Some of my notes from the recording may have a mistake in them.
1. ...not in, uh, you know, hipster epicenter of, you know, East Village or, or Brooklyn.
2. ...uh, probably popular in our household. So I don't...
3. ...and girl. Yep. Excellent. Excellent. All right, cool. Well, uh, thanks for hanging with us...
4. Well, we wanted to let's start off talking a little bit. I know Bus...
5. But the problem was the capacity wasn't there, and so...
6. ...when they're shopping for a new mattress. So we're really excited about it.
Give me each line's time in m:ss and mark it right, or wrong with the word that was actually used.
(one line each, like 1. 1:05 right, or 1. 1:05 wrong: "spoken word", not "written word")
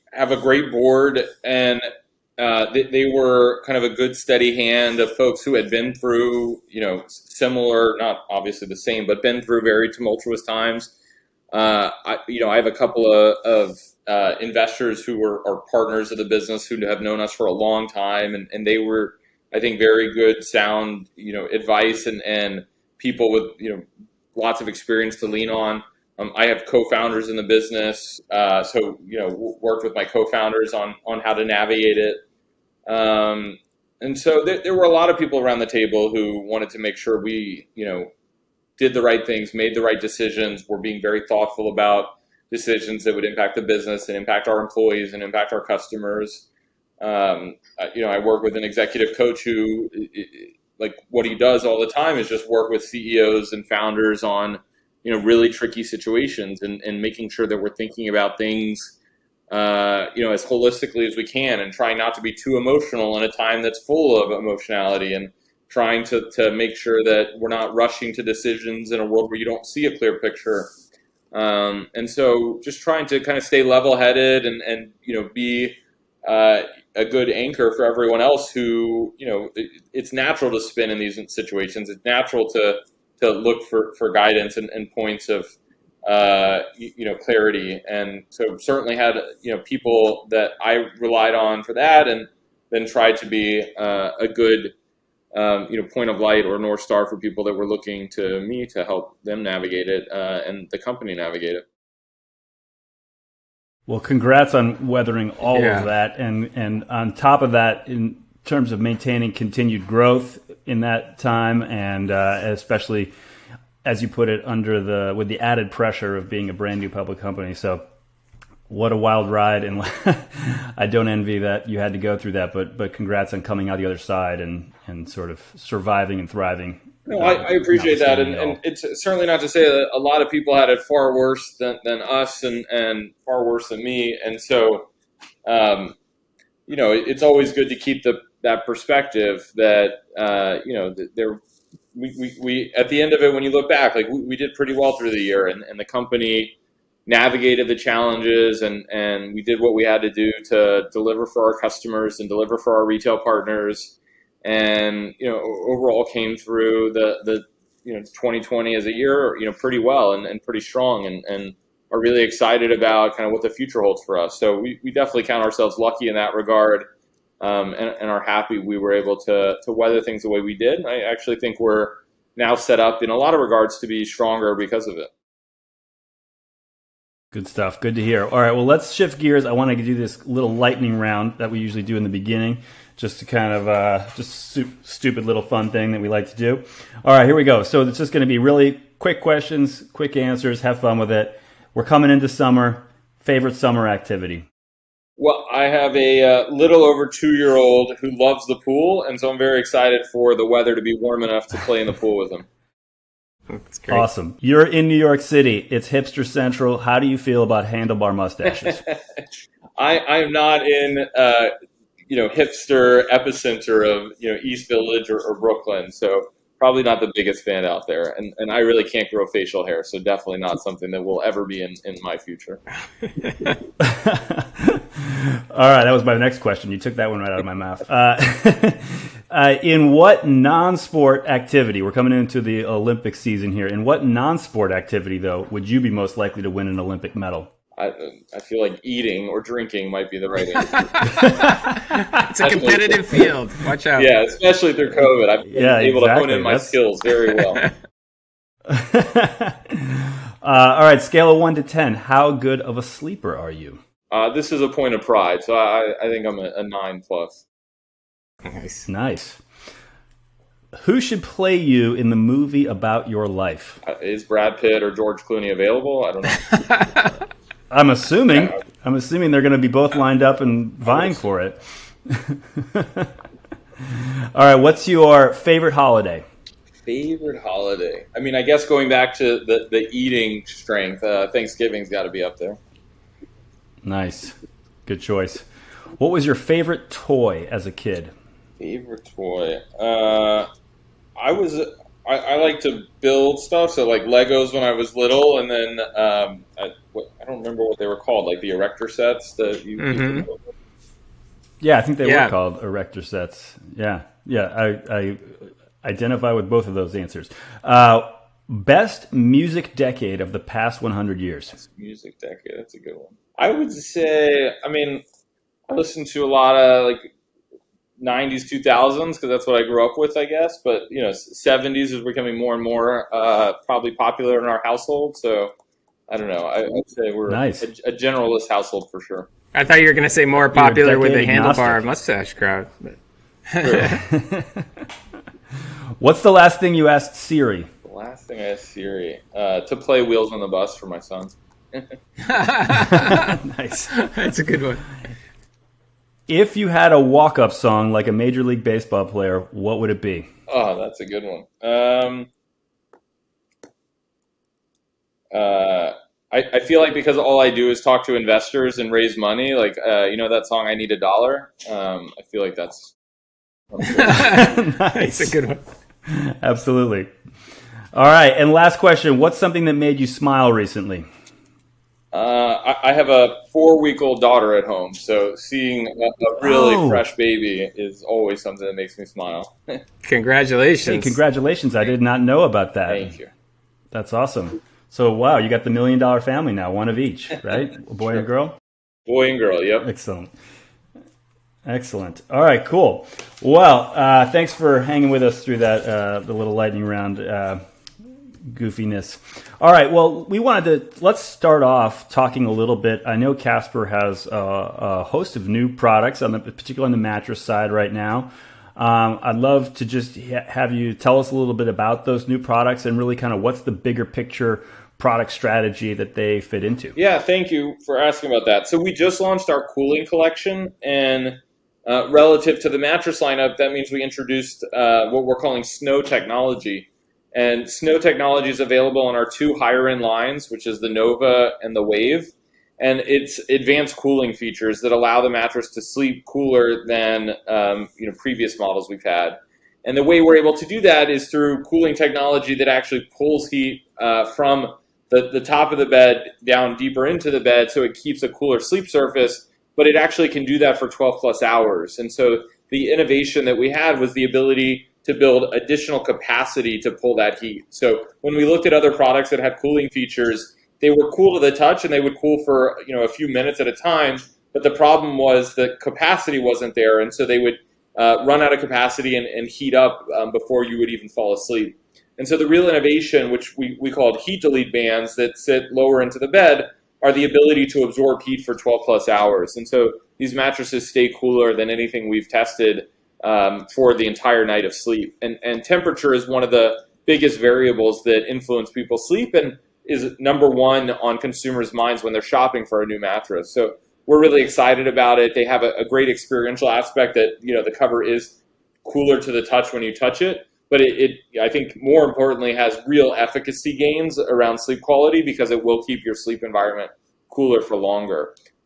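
1. 3:30 right
2. 5:23 right
3. 6:29 right
4. 6:39 wrong: "Casper", not "Bus"
5. 7:44 right
6. 8:12 right.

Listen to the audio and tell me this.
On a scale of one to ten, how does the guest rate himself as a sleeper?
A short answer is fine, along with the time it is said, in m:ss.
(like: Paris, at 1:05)
9 plus, at 4:16.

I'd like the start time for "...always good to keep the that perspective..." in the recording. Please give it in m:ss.
2:17.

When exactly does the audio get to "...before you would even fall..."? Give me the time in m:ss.
7:50.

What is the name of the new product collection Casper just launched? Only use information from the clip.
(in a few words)
Cooling collection.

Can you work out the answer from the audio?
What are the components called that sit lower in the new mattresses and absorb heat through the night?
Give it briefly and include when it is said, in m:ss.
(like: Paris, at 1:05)
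Heat delete bands, at 7:54.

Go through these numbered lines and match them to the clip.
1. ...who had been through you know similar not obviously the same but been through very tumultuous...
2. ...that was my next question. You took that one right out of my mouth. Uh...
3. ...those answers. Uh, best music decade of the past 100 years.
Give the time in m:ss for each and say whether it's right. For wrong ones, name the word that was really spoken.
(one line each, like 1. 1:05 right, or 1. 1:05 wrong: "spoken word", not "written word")
1. 0:05 right
2. 3:45 right
3. 5:06 right.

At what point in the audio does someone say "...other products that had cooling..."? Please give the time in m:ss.
7:38.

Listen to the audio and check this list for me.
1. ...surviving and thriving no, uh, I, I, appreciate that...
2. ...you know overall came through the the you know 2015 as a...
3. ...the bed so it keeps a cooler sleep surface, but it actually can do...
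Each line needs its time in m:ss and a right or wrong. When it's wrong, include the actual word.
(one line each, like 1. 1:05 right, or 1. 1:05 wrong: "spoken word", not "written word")
1. 2:05 right
2. 2:35 wrong: "2020", not "2015"
3. 7:27 right.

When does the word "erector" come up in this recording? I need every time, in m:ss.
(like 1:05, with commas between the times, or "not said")
4:58, 5:02.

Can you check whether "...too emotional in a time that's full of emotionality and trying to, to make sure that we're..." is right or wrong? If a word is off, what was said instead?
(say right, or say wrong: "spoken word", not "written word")
right.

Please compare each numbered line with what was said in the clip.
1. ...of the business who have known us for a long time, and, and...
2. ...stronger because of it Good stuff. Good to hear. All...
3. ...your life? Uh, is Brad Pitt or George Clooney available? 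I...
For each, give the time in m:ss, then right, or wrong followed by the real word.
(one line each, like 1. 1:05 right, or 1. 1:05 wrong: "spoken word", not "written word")
1. 0:16 right
2. 2:54 right
3. 4:23 right.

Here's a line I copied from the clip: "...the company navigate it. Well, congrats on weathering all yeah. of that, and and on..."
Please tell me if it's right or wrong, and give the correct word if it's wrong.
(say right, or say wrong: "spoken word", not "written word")
right.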